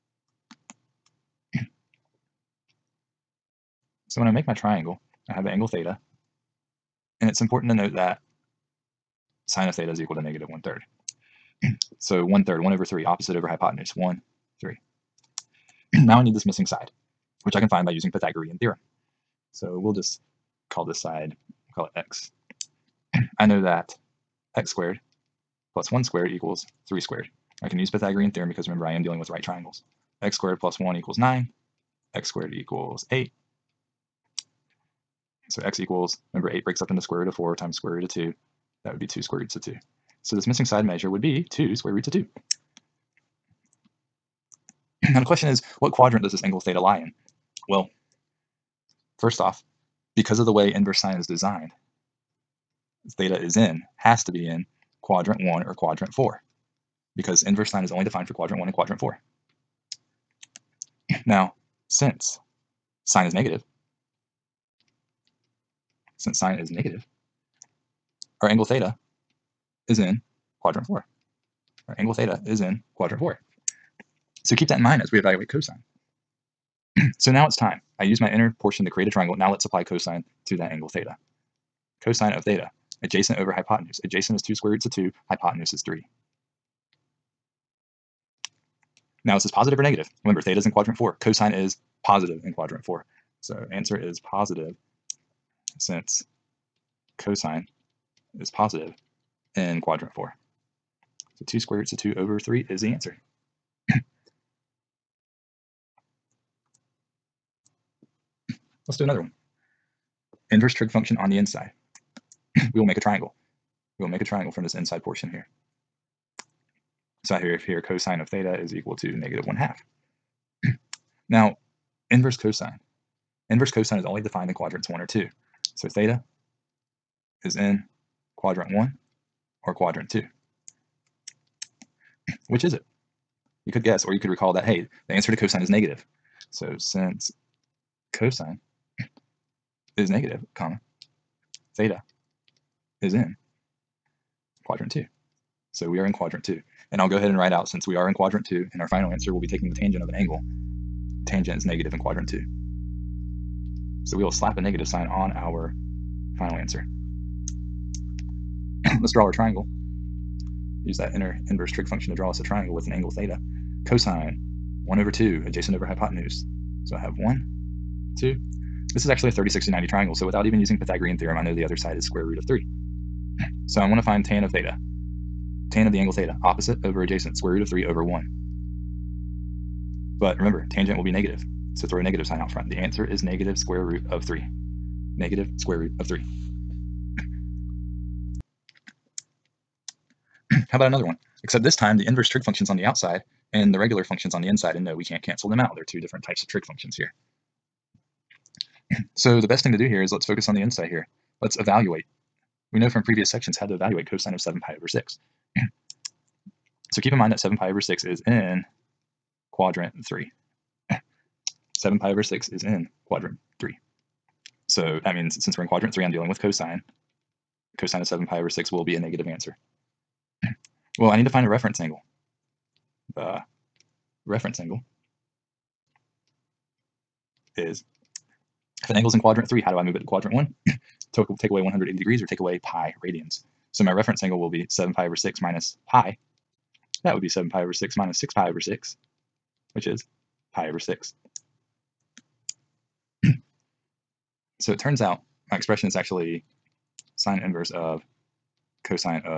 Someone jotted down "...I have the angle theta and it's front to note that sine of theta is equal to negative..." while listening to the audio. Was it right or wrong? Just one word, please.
wrong.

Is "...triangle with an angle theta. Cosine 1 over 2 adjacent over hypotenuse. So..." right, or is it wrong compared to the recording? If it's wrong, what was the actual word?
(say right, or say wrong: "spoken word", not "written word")
right.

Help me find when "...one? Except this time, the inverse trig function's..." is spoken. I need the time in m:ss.
3:11.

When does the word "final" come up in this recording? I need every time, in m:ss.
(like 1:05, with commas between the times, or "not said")
2:28, 2:36.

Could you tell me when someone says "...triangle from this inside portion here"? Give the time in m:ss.
1:54.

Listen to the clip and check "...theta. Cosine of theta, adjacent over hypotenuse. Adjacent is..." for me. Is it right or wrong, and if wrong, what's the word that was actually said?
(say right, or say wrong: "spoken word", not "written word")
right.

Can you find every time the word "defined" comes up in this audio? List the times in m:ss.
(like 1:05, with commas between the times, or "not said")
0:58, 2:04.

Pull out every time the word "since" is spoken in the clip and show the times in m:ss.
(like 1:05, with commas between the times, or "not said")
1:01, 1:06, 1:35, 2:16, 2:27, 3:35.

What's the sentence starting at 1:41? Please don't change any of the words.
So 2 square roots of 2 over 3 is the answer.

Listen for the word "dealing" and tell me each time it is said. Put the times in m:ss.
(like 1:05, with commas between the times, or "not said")
0:29, 3:36.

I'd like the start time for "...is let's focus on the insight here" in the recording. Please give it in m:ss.
3:20.